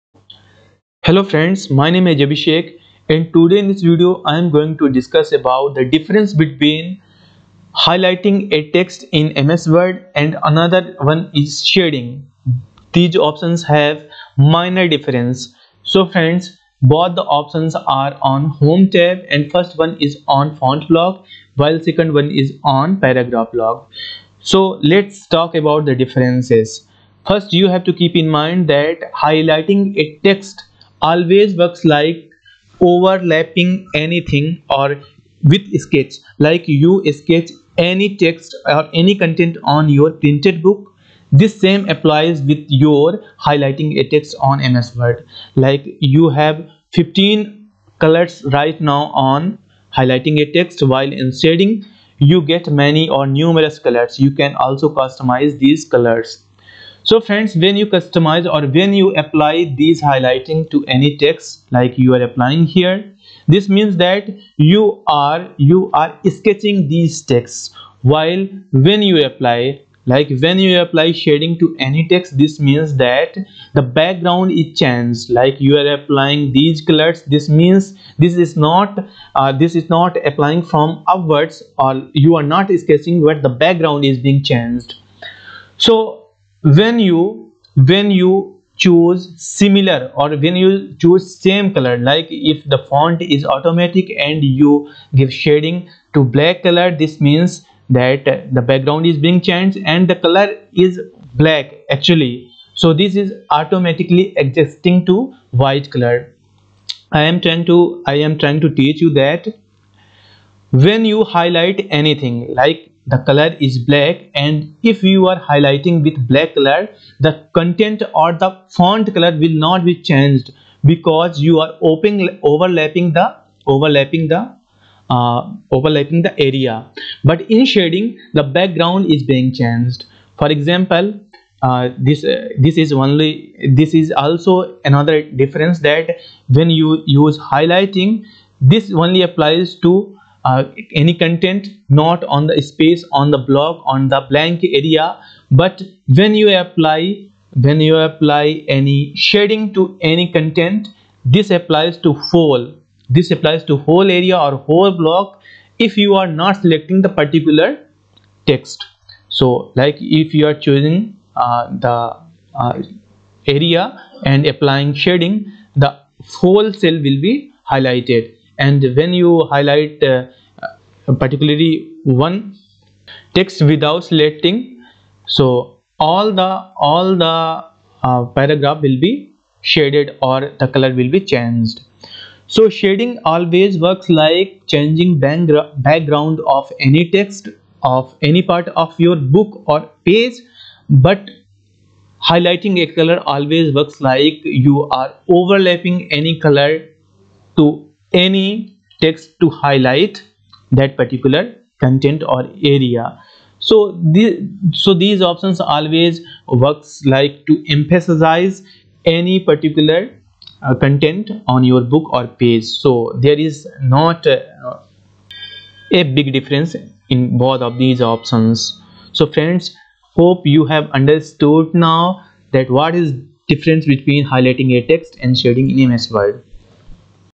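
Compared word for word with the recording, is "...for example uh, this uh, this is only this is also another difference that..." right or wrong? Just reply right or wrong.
right.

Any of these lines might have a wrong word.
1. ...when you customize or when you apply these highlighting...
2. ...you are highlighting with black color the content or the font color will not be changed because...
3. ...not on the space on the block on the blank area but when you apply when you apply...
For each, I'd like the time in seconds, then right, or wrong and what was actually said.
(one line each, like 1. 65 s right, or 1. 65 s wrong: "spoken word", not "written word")
1. 57 s right
2. 115 s right
3. 141 s right.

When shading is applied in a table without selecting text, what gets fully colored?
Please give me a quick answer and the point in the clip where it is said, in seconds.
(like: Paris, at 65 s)
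The whole cell, at 166 s.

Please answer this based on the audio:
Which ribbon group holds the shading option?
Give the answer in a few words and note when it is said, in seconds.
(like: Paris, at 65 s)
Paragraph block, at 23 s.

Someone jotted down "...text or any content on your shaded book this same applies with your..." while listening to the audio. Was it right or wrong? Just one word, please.
wrong.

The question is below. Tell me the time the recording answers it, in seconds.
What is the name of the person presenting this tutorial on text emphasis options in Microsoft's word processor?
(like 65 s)
2 s.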